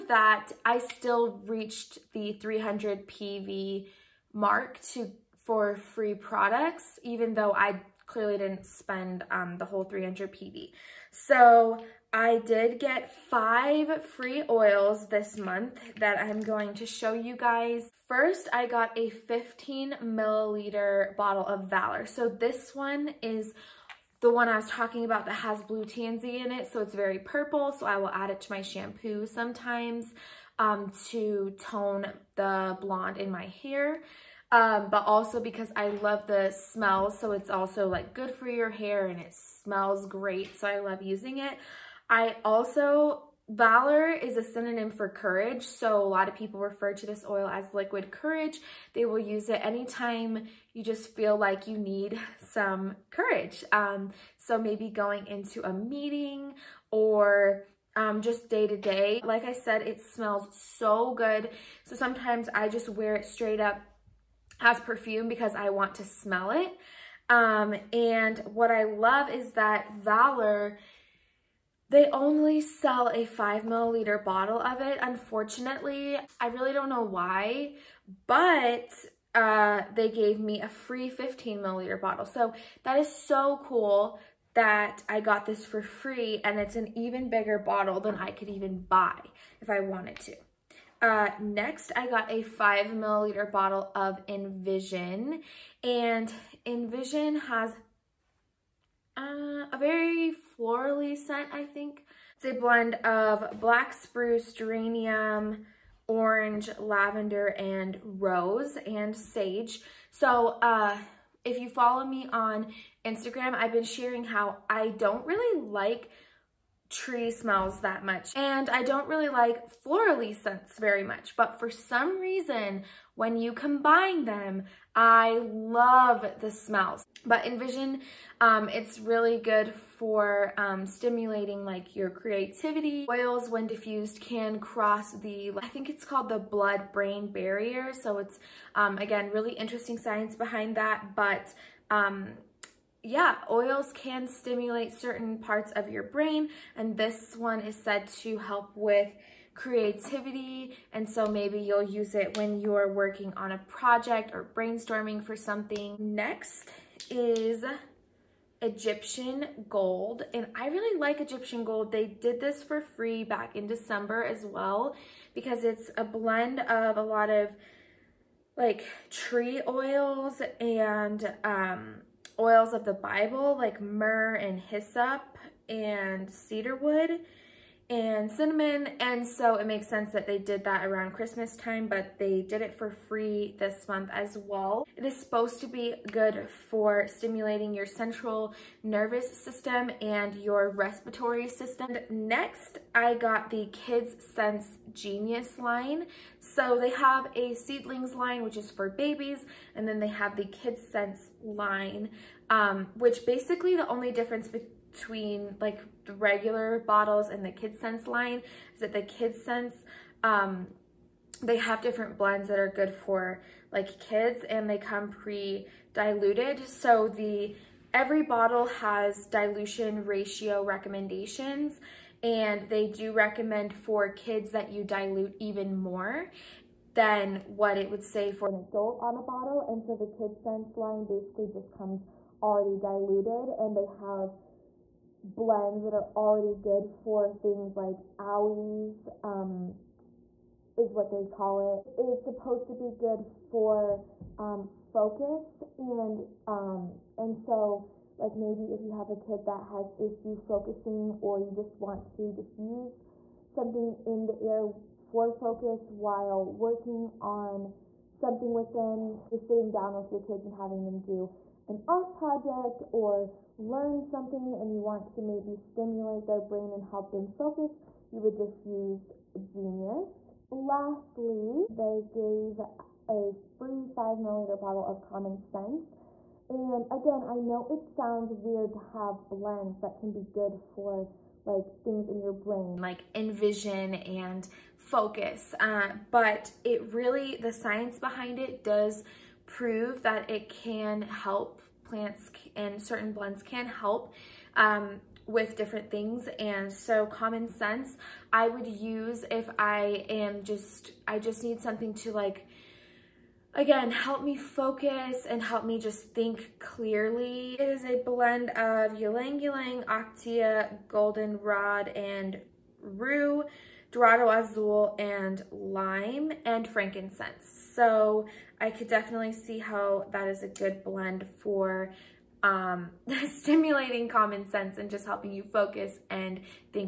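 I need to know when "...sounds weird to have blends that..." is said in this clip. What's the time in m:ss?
4:37.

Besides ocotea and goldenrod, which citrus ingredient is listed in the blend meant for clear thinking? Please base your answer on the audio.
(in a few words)
Lime.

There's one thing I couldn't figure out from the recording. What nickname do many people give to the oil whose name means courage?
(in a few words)
liquid courage.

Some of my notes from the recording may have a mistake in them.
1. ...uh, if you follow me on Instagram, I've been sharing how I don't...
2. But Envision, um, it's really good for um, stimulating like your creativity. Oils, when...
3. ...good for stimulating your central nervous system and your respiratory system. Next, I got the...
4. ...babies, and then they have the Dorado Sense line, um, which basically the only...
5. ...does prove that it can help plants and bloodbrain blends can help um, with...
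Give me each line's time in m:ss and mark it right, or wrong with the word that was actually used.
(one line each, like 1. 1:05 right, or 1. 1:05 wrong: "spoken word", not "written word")
1. 1:50 right
2. 2:07 right
3. 3:06 right
4. 3:18 wrong: "Kids", not "Dorado"
5. 4:48 wrong: "certain", not "bloodbrain".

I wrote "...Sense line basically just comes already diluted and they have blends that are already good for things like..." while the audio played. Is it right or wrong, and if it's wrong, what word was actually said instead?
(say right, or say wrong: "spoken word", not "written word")
right.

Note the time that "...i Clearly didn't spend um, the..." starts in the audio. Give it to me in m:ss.
0:07.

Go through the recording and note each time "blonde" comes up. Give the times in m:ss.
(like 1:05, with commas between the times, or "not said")
0:32.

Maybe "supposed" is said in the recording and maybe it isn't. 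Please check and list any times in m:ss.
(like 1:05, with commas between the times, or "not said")
3:05, 4:02.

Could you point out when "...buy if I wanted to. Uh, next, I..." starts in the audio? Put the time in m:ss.
1:28.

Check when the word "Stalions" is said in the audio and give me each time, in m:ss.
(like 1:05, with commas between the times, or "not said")
not said.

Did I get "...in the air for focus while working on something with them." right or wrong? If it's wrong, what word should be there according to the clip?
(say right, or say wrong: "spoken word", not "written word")
right.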